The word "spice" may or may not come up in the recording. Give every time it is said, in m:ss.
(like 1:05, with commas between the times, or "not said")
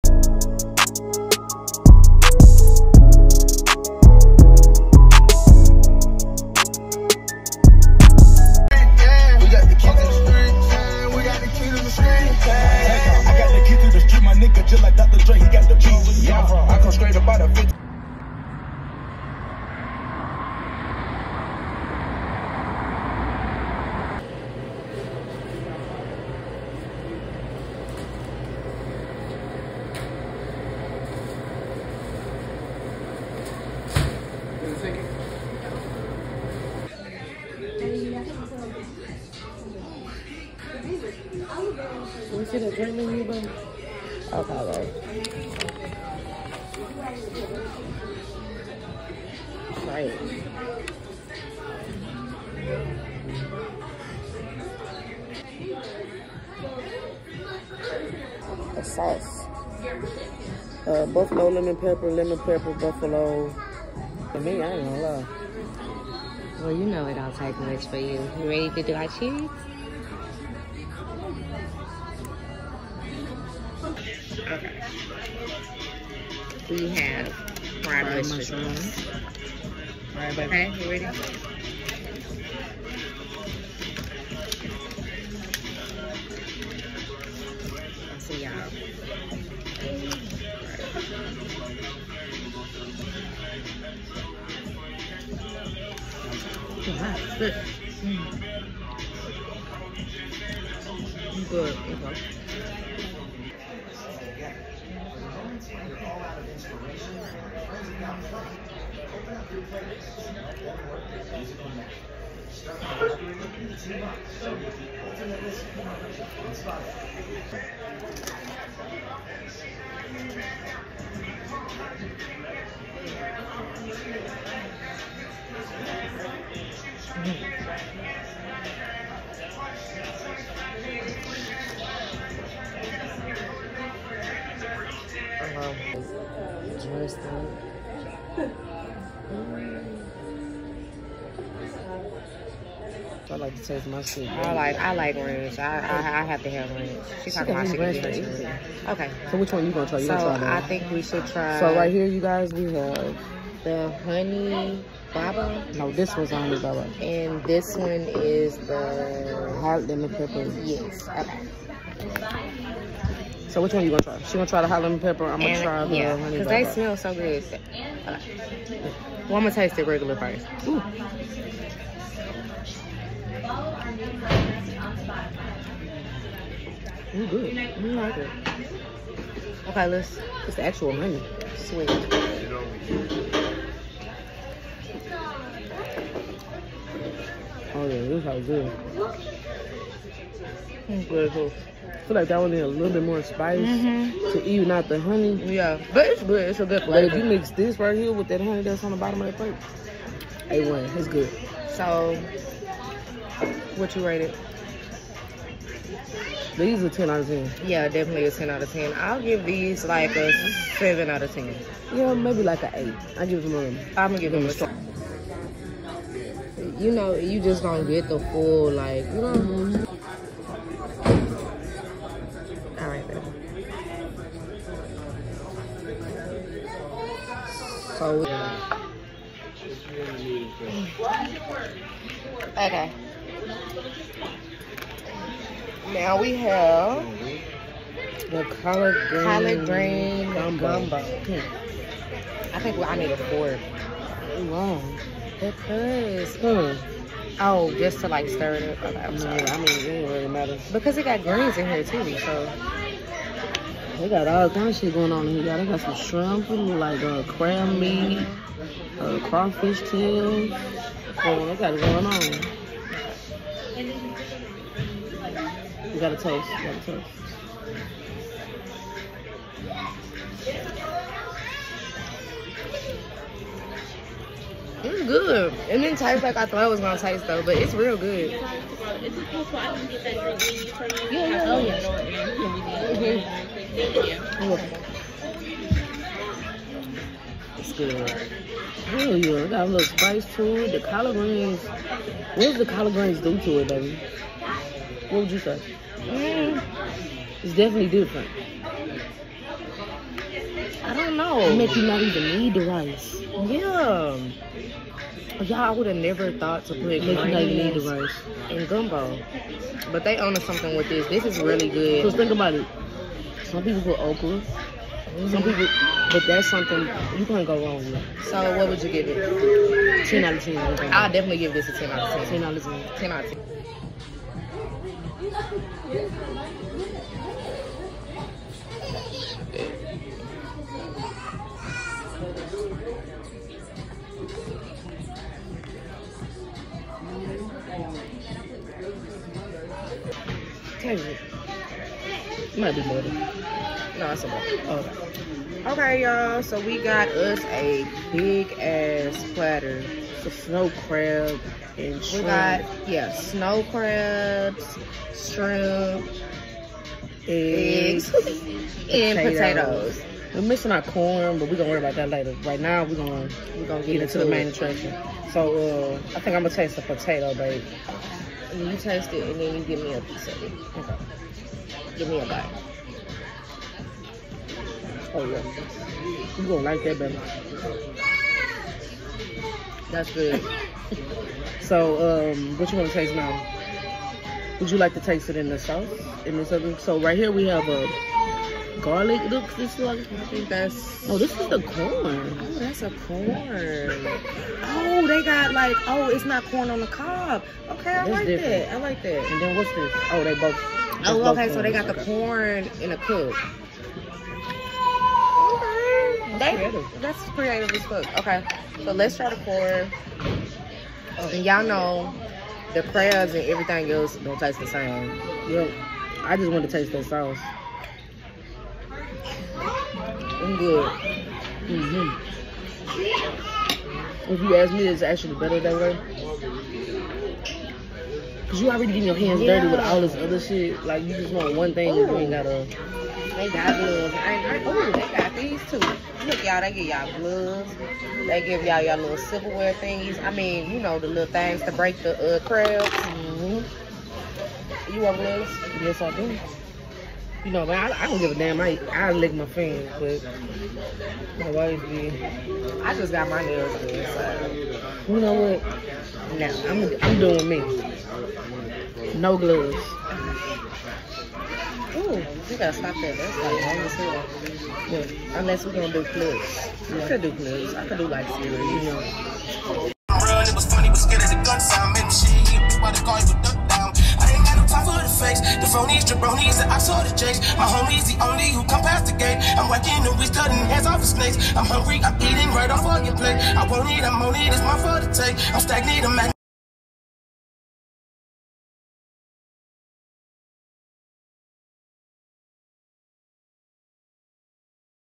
3:13, 4:49.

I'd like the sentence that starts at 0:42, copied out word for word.
We should have dreamed you, but.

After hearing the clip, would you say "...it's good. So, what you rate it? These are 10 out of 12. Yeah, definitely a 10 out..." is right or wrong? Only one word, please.
wrong.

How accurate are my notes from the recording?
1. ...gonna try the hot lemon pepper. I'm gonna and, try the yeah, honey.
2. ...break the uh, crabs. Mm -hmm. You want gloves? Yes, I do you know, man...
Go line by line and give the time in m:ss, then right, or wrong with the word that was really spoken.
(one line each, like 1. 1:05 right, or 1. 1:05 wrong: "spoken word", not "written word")
1. 2:44 right
2. 7:21 right.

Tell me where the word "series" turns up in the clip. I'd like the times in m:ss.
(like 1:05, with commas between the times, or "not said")
7:48.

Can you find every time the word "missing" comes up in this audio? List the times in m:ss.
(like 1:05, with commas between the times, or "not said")
6:00.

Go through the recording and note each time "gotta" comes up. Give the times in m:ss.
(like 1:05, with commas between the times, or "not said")
7:42.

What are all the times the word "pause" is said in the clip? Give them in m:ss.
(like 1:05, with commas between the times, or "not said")
not said.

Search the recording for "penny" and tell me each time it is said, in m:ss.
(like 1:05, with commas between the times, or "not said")
not said.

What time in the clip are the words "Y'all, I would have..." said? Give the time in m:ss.
5:05.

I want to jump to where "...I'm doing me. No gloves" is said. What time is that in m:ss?
7:37.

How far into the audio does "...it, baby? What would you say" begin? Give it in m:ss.
4:53.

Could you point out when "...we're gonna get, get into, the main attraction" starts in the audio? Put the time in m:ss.
6:03.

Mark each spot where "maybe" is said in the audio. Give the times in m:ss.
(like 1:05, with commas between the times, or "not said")
3:32.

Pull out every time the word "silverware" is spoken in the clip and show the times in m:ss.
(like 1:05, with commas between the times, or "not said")
7:19.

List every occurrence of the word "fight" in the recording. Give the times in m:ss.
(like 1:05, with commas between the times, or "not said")
not said.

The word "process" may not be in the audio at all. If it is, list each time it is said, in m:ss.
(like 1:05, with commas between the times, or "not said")
not said.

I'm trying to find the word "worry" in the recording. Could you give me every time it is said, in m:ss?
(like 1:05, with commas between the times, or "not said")
6:01.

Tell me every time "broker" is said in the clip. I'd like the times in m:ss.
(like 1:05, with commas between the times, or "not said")
not said.